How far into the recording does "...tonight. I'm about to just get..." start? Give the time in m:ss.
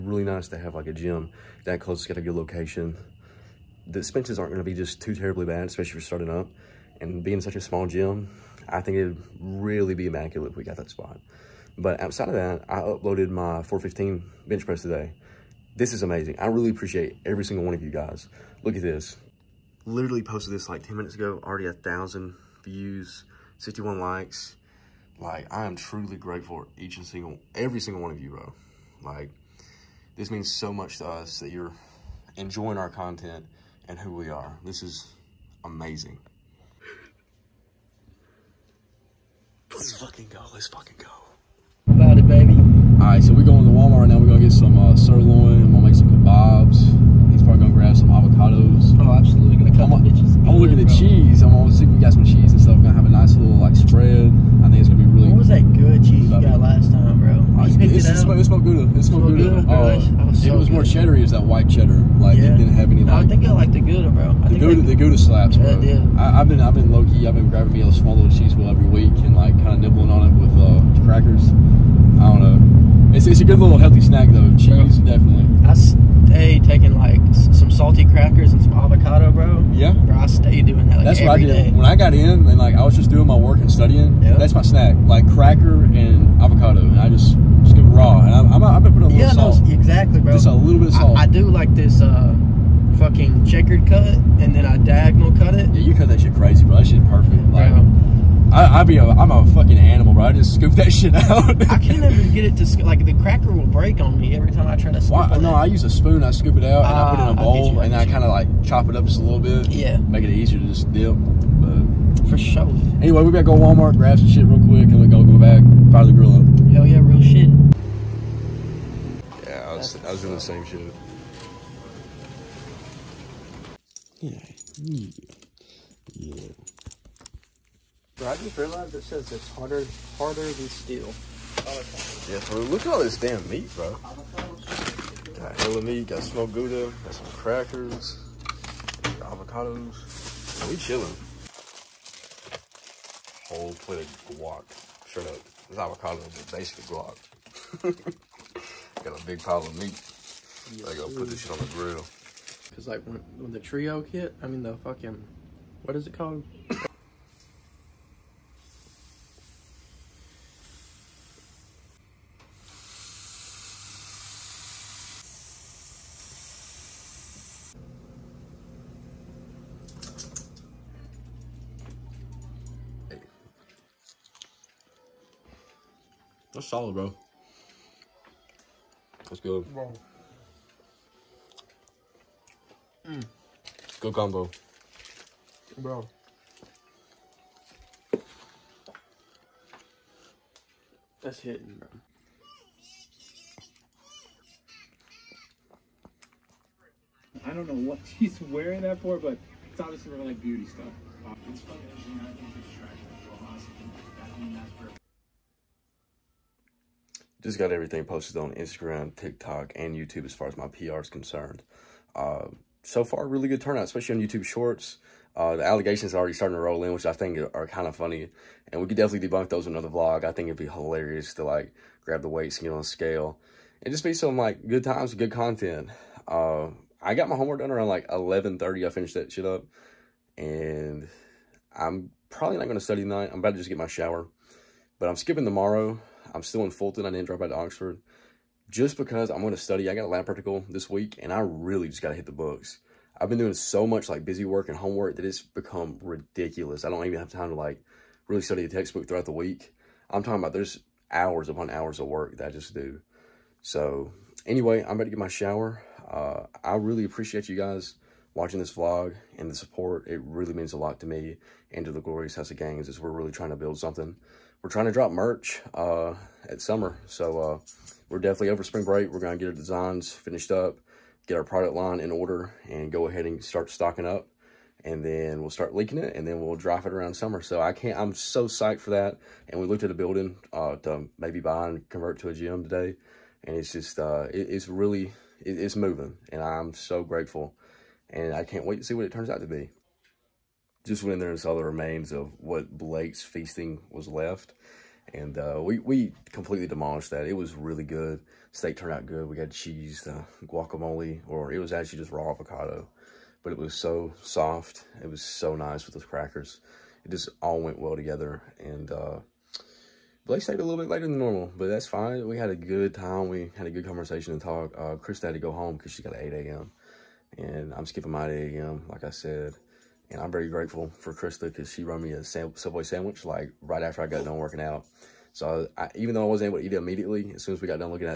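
3:53.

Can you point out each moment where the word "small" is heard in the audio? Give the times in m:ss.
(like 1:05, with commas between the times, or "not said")
0:07, 1:07.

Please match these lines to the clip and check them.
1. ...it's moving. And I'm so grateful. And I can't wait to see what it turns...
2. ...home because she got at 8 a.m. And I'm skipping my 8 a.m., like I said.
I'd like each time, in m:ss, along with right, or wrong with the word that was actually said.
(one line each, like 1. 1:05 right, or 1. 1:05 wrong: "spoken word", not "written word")
1. 4:45 right
2. 5:15 right.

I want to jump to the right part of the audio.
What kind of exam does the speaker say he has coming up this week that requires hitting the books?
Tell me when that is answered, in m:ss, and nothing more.
4:00.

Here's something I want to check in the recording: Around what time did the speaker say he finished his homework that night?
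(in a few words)
11:30.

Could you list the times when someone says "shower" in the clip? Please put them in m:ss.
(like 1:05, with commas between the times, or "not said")
3:53, 4:15.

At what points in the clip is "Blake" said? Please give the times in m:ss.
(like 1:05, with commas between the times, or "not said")
4:52, 5:10.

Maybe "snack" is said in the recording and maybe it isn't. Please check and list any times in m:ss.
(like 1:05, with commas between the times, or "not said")
1:13, 1:24.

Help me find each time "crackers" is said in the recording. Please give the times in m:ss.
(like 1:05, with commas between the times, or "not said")
1:11, 1:18, 1:25, 1:43, 2:17, 5:06.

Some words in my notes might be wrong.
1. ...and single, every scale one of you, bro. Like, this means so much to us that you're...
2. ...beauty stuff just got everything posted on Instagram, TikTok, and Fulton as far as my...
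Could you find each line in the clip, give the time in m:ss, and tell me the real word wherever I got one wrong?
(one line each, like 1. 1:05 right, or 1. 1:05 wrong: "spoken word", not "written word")
1. 0:26 wrong: "single", not "scale"
2. 3:20 wrong: "YouTube", not "Fulton".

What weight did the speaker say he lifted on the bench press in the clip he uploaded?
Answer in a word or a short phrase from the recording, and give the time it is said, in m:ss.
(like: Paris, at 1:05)
415, at 0:13.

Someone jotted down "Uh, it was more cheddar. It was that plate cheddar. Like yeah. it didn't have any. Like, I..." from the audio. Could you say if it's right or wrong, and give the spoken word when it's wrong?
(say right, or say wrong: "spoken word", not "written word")
wrong: "white", not "plate".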